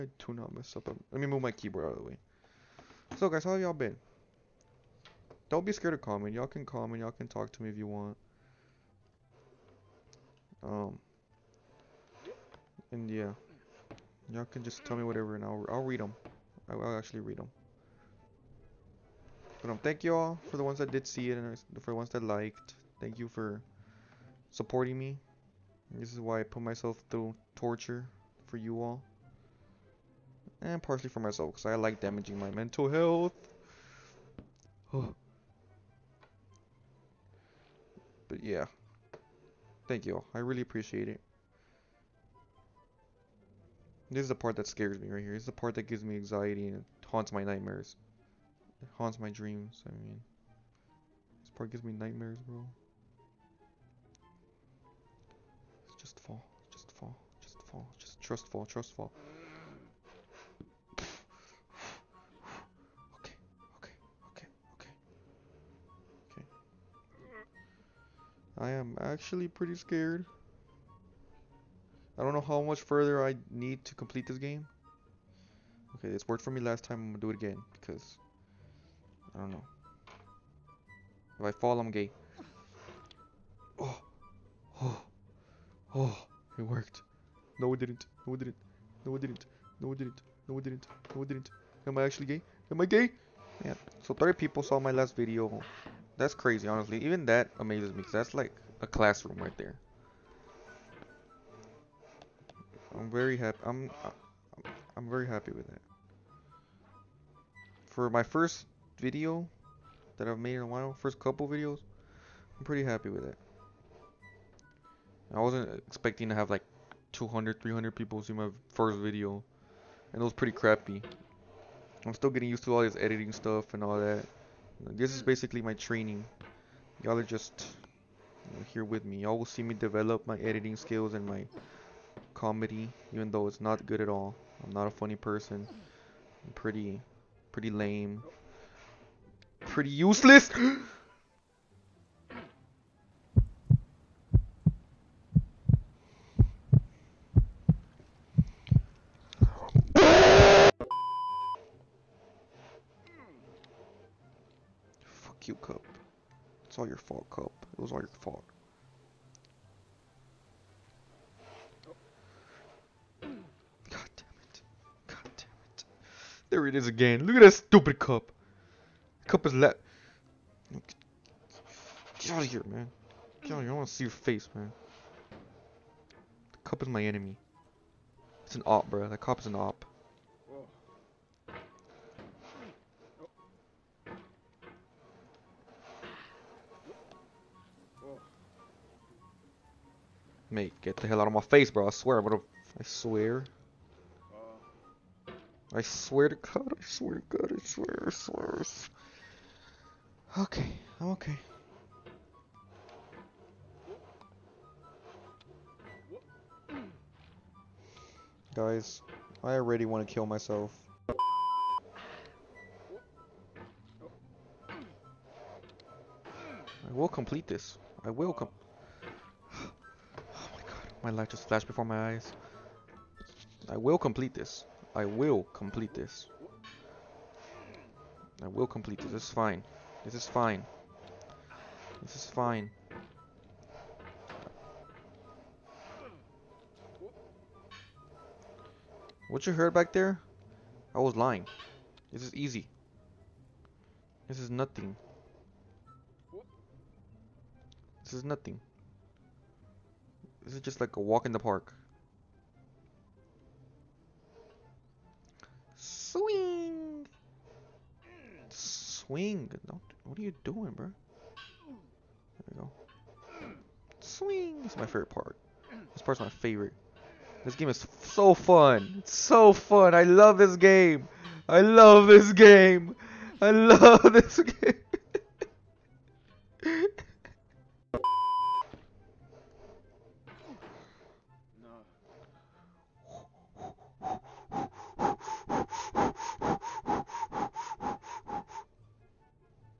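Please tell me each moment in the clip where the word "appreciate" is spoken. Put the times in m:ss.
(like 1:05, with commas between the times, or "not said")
0:40.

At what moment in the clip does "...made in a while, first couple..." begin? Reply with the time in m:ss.
1:50.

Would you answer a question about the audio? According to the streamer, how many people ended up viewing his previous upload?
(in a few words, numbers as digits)
30.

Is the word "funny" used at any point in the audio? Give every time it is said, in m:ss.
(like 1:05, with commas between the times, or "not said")
2:14.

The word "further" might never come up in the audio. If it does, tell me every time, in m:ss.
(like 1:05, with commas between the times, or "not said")
1:12.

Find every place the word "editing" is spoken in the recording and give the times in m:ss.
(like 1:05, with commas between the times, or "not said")
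2:02, 2:10.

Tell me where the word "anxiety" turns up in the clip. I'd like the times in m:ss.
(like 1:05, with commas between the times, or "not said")
0:46.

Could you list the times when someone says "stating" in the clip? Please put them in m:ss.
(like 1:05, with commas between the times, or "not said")
not said.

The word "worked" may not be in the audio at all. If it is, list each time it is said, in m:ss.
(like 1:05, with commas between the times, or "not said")
1:16, 1:26.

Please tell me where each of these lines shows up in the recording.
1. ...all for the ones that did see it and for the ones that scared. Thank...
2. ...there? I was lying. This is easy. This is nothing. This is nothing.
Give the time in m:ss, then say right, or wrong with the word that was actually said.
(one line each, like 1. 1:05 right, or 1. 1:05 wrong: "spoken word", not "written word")
1. 0:20 wrong: "liked", not "scared"
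2. 3:59 right.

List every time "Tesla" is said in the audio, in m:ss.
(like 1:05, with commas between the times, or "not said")
not said.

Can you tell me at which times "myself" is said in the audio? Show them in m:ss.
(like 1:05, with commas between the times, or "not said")
0:26, 0:31, 3:30.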